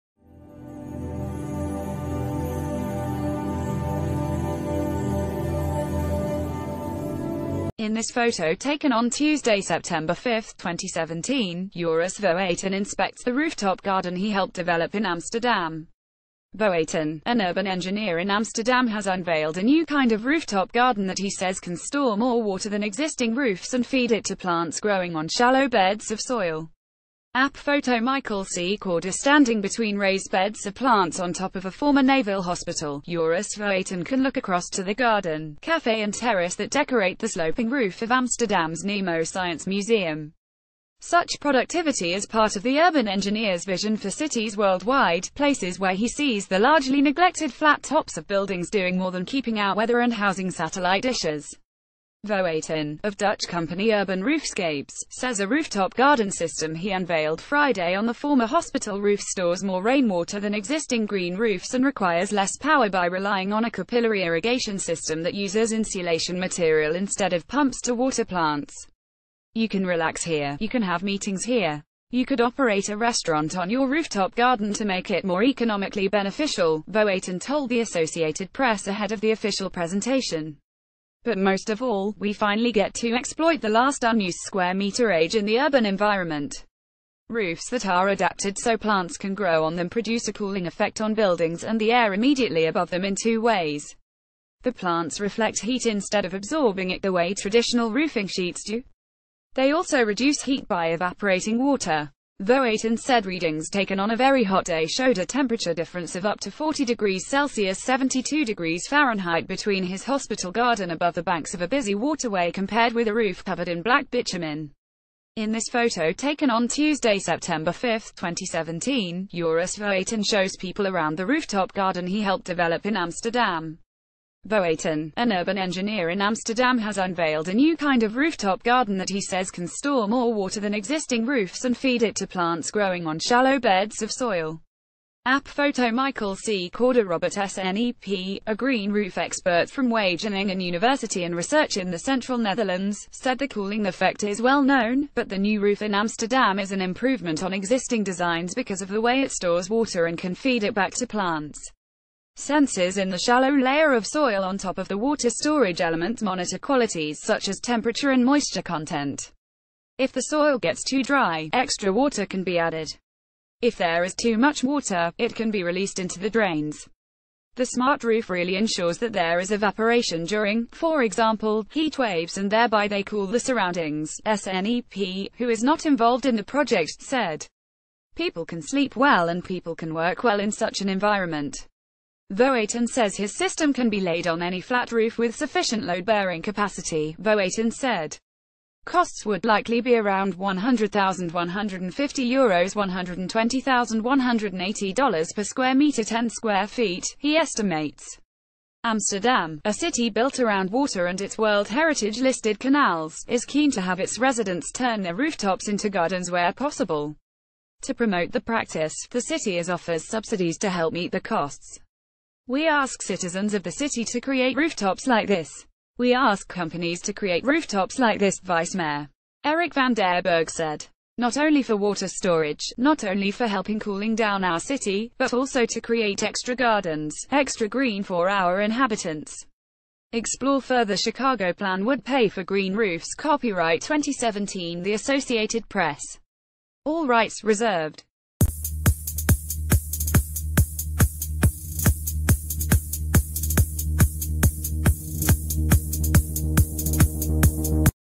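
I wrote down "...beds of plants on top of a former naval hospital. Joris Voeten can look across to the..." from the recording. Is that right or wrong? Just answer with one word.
right.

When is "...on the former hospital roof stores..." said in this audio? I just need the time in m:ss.
0:57.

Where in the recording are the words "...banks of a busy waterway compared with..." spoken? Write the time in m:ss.
1:51.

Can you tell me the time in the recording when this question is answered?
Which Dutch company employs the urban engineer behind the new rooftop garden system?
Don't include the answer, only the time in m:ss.
0:53.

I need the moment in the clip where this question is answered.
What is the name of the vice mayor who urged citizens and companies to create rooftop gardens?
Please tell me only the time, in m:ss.
3:39.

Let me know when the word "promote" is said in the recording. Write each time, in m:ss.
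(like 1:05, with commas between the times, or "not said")
3:27.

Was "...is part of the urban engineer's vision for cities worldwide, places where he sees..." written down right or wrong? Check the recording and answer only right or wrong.
right.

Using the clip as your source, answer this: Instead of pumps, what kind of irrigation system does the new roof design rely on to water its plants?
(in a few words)
capillary irrigation system.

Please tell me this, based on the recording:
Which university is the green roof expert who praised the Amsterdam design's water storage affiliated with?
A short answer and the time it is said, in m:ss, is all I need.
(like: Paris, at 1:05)
Wageningen University, at 2:19.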